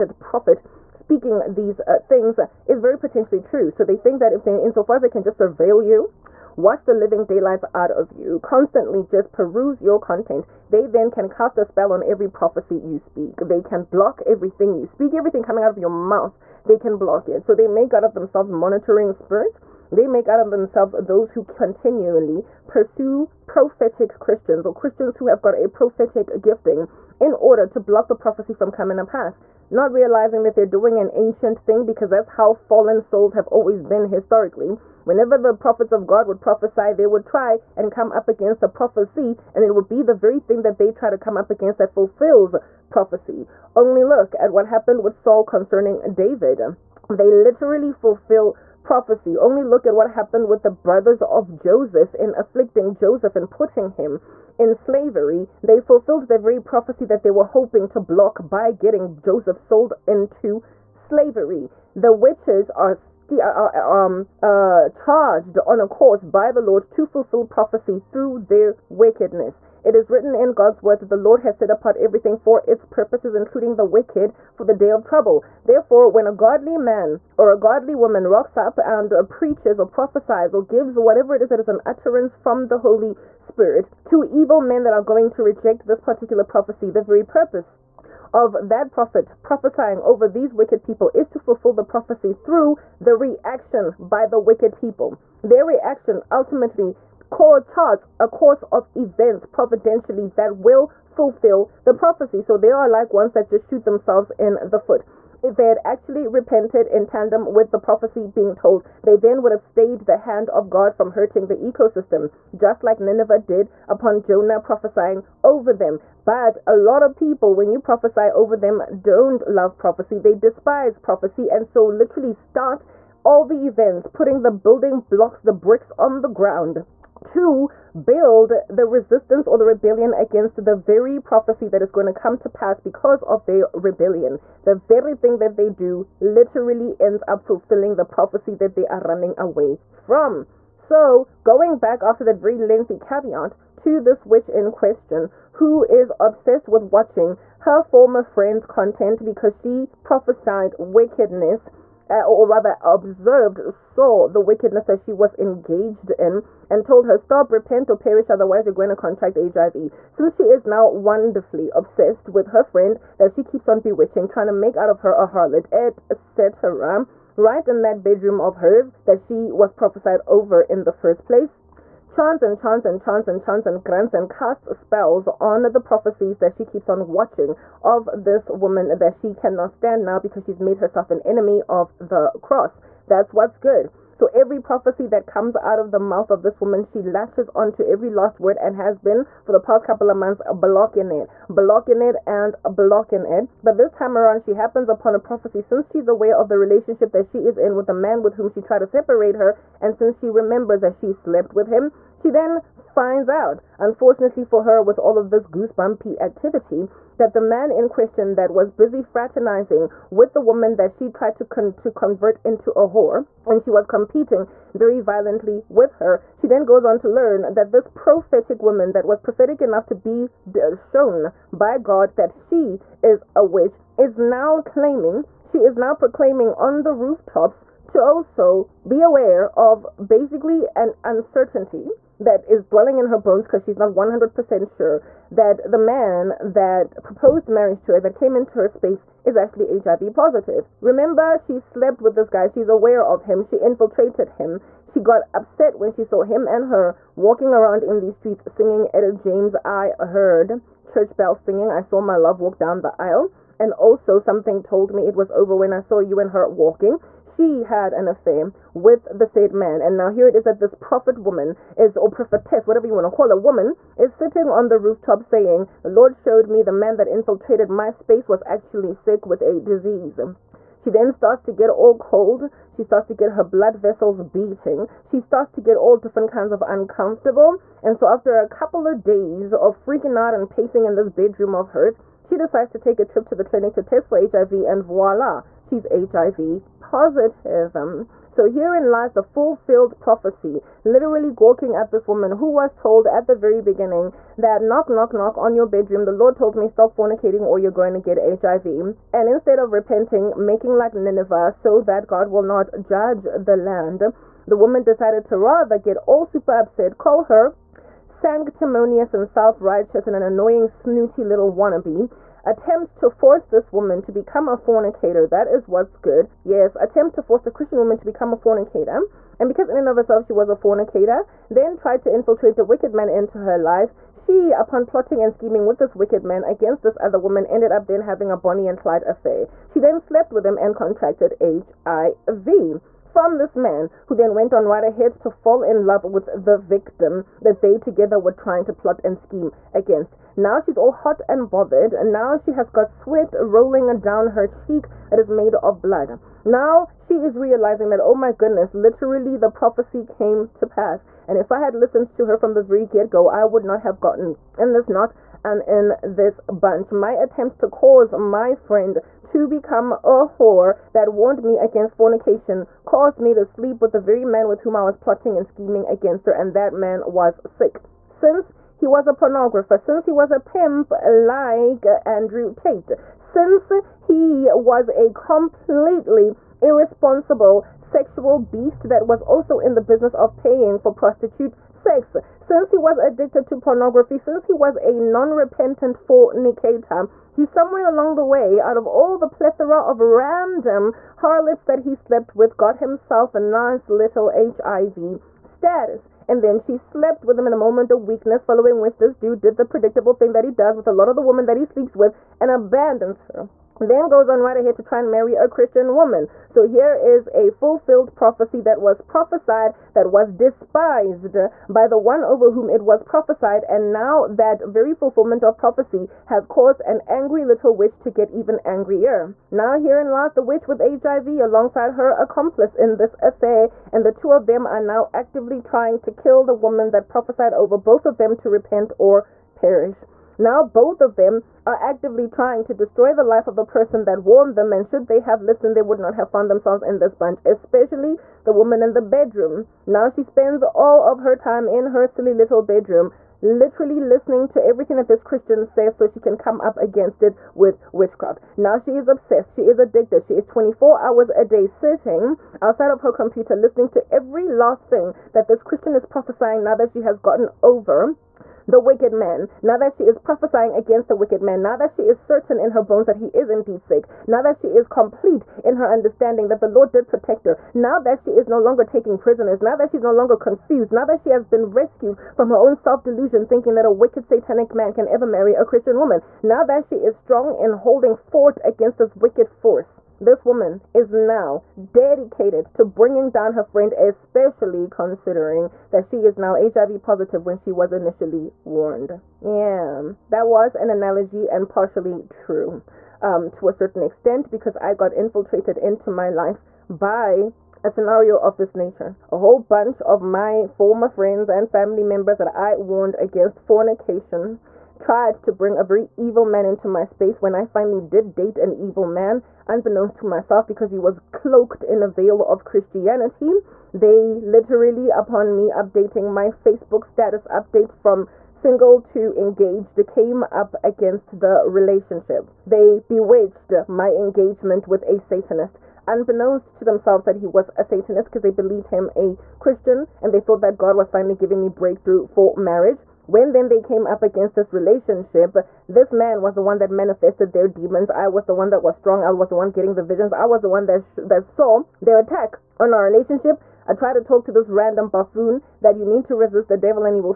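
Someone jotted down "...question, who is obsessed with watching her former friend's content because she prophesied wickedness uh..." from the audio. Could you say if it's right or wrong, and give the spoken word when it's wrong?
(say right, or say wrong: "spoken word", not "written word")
right.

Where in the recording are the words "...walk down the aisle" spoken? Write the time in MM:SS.
04:12.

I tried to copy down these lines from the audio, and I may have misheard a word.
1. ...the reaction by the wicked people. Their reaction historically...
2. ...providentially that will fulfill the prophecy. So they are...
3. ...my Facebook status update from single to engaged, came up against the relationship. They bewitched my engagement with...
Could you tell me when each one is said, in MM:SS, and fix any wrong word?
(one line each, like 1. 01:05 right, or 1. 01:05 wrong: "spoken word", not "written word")
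1. 01:32 wrong: "ultimately", not "historically"
2. 01:39 right
3. 08:36 right.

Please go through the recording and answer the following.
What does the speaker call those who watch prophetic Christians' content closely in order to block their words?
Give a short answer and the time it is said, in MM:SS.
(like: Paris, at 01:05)
monitoring spirits, at 00:18.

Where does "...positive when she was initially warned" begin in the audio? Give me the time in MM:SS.
08:07.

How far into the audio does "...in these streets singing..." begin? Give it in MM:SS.
04:07.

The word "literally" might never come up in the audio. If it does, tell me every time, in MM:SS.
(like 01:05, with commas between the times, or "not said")
00:47, 02:01, 02:16, 04:50, 05:48, 07:23, 08:34.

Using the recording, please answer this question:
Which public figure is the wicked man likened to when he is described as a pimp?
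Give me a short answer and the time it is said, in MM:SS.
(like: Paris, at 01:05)
Andrew Tate, at 06:12.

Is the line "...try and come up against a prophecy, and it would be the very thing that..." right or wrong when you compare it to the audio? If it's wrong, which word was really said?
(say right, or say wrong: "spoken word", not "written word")
right.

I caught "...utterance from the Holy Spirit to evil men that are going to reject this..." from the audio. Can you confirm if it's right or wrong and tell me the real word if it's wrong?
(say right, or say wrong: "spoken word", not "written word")
right.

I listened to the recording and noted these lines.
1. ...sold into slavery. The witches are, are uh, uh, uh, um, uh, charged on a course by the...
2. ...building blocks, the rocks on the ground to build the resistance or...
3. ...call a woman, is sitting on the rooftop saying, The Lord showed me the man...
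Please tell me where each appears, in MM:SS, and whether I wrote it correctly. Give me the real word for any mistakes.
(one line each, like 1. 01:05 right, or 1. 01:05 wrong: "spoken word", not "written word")
1. 00:59 right
2. 02:04 wrong: "bricks", not "rocks"
3. 04:23 right.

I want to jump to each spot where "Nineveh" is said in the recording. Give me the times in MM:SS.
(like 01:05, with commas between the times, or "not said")
01:52, 05:00.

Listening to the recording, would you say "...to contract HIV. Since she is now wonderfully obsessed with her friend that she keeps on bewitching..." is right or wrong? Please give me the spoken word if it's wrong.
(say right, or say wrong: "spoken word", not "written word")
right.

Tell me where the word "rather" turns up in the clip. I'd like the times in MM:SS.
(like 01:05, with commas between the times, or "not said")
02:32, 05:05.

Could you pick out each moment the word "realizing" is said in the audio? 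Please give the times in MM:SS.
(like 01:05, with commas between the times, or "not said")
00:29, 05:47.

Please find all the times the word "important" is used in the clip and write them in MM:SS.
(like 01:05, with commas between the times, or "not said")
not said.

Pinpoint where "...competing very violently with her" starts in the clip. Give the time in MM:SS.
03:33.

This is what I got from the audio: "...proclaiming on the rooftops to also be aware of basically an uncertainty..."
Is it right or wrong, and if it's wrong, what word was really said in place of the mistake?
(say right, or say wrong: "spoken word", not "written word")
right.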